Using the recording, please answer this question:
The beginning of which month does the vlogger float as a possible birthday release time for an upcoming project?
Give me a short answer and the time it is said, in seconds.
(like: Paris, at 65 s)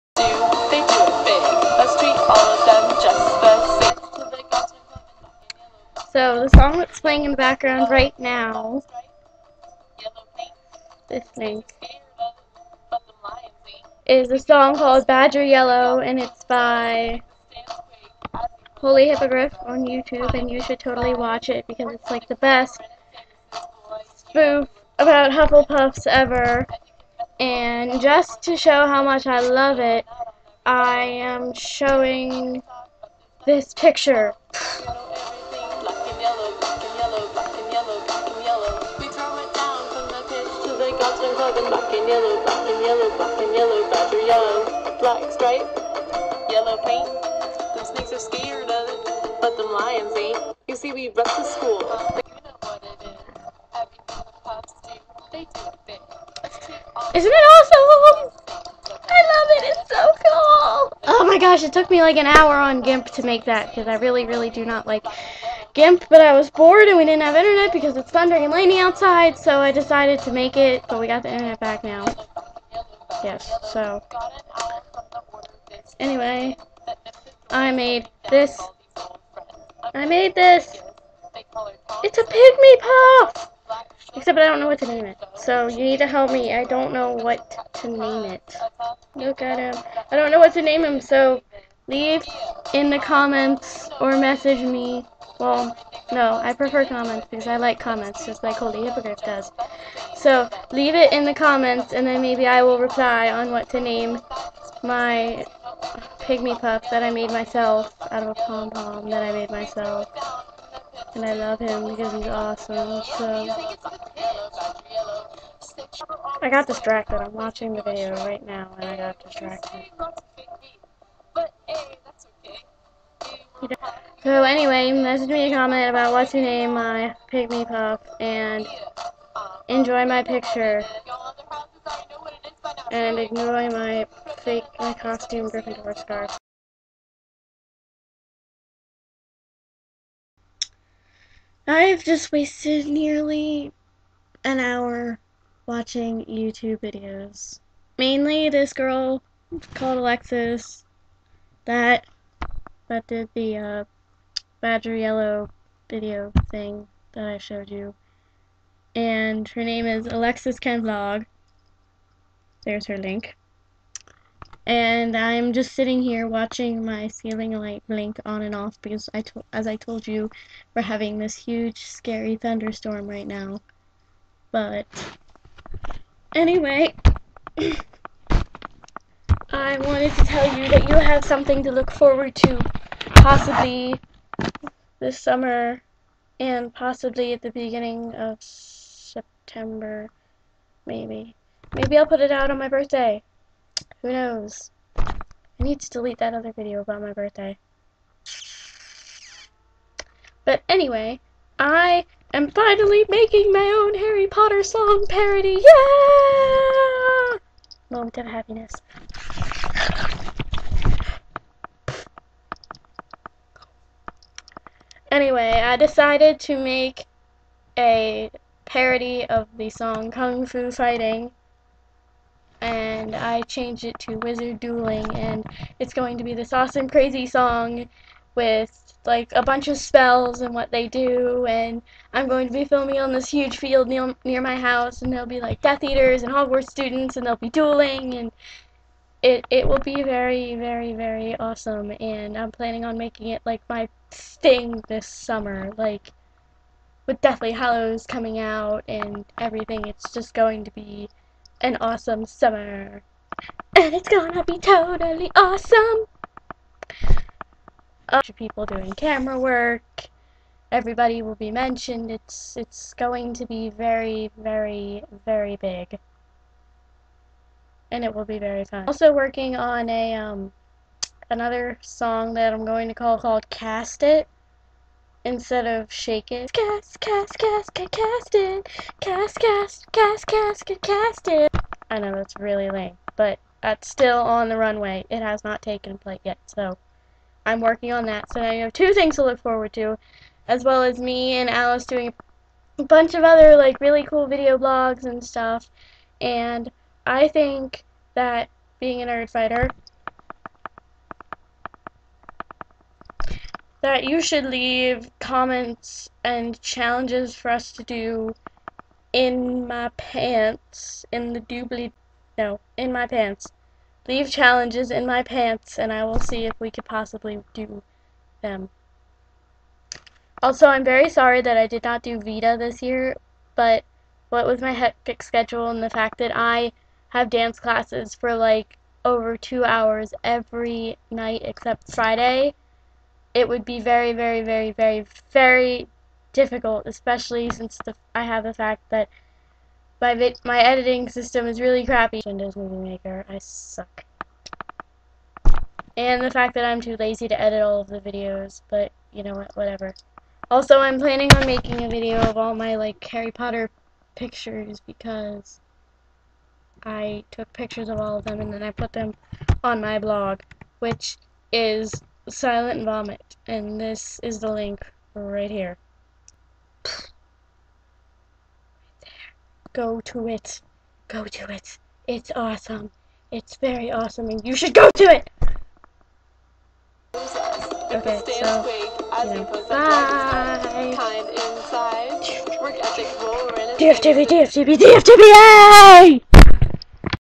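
September, at 188 s.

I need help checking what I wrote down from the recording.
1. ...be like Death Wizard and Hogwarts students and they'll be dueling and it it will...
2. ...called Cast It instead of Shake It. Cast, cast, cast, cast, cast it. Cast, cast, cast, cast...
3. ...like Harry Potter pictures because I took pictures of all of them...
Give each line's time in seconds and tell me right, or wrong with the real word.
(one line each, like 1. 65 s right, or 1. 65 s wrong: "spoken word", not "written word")
1. 235 s wrong: "Eaters", not "Wizard"
2. 273 s right
3. 352 s right.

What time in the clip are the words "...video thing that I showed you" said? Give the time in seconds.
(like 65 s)
155 s.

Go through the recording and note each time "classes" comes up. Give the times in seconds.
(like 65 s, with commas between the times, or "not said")
327 s.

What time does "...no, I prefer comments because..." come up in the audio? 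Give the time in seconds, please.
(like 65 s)
96 s.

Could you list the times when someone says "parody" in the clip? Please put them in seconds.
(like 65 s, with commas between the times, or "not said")
205 s, 218 s.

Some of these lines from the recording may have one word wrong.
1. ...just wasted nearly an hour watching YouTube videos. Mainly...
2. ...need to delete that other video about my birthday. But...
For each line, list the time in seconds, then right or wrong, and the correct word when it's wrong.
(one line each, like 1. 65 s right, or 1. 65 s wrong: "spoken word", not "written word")
1. 142 s right
2. 195 s right.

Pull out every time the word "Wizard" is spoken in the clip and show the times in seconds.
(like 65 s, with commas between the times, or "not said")
224 s.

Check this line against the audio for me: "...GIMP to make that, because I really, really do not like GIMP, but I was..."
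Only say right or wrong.
right.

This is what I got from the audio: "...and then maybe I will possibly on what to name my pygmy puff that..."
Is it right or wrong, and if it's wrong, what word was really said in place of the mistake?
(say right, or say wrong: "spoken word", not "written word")
wrong: "reply", not "possibly".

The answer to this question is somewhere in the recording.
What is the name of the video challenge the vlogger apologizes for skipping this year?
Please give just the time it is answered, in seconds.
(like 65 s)
322 s.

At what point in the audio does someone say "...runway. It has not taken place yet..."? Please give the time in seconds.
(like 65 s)
284 s.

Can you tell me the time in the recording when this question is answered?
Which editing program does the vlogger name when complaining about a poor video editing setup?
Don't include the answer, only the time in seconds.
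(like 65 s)
342 s.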